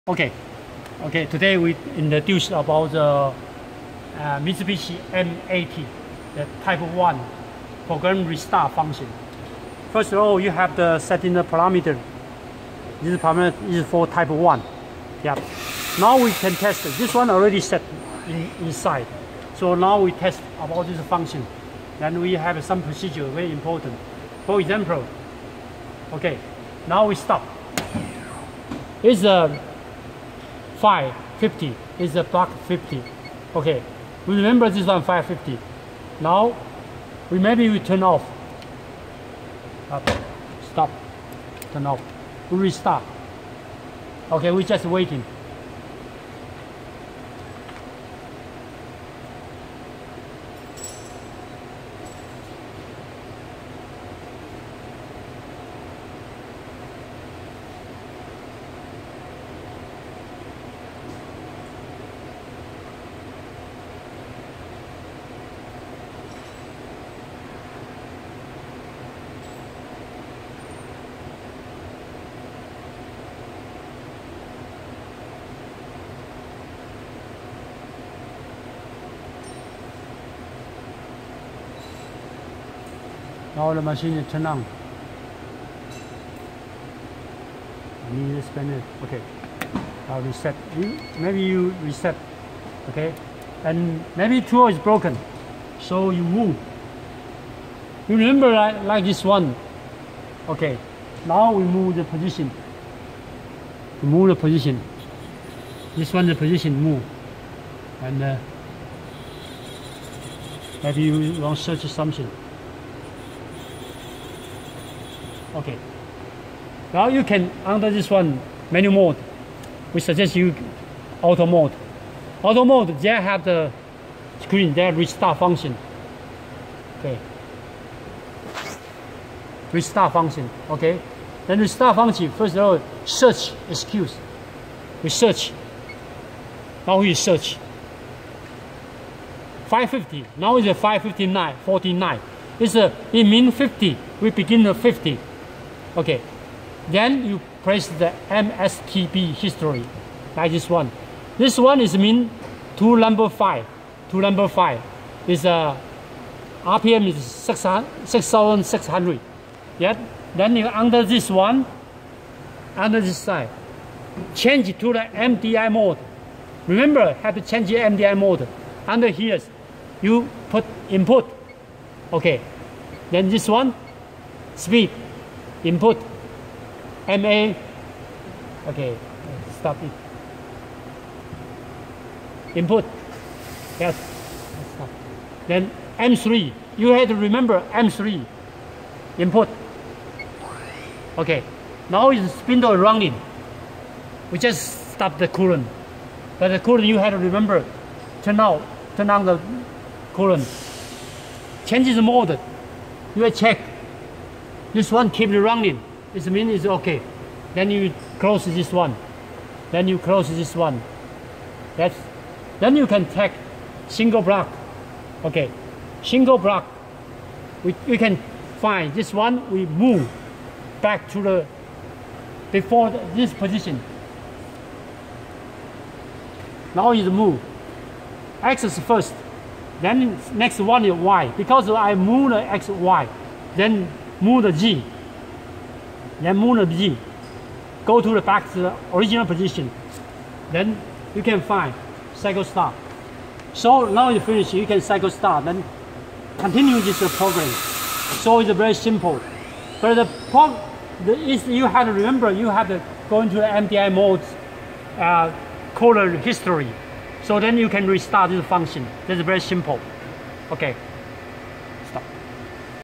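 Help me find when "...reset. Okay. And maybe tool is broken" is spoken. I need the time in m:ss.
1:31.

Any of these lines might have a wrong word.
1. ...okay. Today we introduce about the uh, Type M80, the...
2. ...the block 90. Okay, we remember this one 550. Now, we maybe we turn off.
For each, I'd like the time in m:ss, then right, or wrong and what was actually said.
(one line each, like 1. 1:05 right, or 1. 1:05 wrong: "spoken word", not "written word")
1. 0:01 wrong: "Mitsubishi", not "Type"
2. 0:32 wrong: "50", not "90".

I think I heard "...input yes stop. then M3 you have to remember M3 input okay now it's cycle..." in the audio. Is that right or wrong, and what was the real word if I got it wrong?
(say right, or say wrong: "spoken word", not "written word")
wrong: "spindle", not "cycle".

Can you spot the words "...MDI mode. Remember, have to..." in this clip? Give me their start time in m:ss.
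2:45.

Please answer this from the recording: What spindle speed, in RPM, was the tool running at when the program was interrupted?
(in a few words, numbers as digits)
6,600.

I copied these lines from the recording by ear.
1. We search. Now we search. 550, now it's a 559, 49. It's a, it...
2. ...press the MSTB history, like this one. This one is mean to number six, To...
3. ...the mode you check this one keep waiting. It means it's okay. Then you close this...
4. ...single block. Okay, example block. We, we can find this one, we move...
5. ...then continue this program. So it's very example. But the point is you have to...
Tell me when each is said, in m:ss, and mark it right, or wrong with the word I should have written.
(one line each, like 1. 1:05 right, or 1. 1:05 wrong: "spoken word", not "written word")
1. 2:15 right
2. 2:27 wrong: "five", not "six"
3. 3:21 wrong: "running", not "waiting"
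4. 3:33 wrong: "single", not "example"
5. 4:05 wrong: "simple", not "example".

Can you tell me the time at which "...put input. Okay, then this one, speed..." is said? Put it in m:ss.
2:50.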